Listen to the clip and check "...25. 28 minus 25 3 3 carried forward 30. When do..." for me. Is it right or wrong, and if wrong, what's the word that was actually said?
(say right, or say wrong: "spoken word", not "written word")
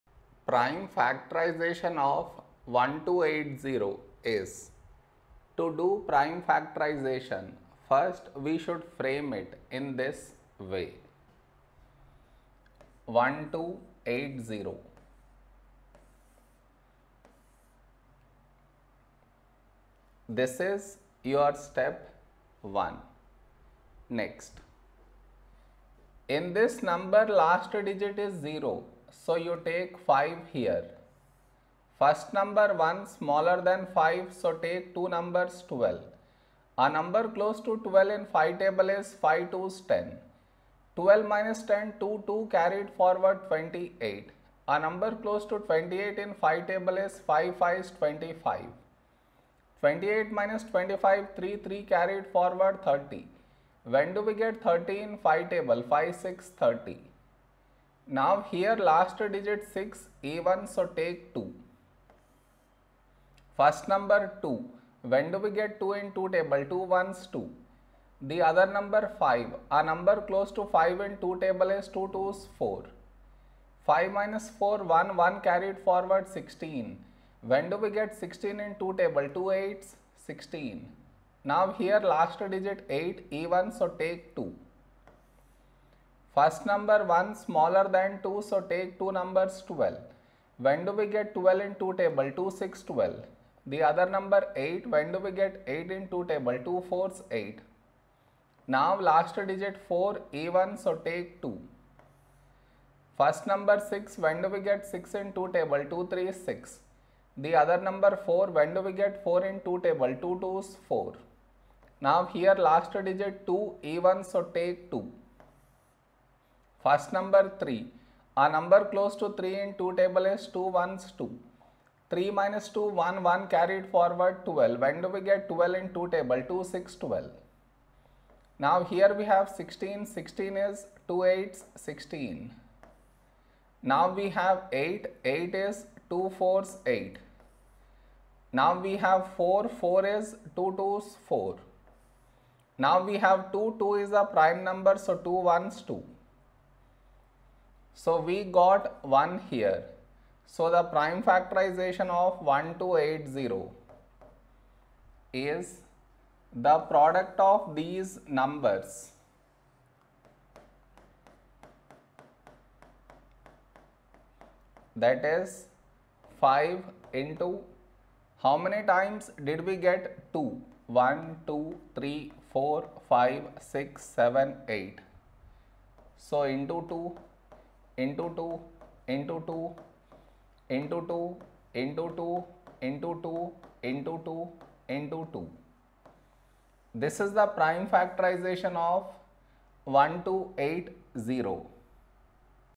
right.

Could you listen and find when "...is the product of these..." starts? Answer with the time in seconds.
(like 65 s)
155 s.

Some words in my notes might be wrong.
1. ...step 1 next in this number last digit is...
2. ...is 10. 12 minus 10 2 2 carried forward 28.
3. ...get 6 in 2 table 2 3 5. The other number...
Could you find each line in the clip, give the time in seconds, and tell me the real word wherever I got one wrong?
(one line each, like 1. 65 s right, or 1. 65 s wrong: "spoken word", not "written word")
1. 21 s right
2. 39 s right
3. 104 s wrong: "6", not "5".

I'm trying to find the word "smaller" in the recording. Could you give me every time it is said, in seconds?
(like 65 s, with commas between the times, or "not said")
33 s, 87 s.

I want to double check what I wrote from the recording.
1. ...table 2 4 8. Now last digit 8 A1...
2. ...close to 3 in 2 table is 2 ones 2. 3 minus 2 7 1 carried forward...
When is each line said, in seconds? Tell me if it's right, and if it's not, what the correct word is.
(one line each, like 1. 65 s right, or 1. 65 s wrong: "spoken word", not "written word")
1. 96 s wrong: "4", not "8"
2. 118 s wrong: "1", not "7".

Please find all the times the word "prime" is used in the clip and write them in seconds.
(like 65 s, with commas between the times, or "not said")
0 s, 6 s, 144 s, 150 s, 187 s.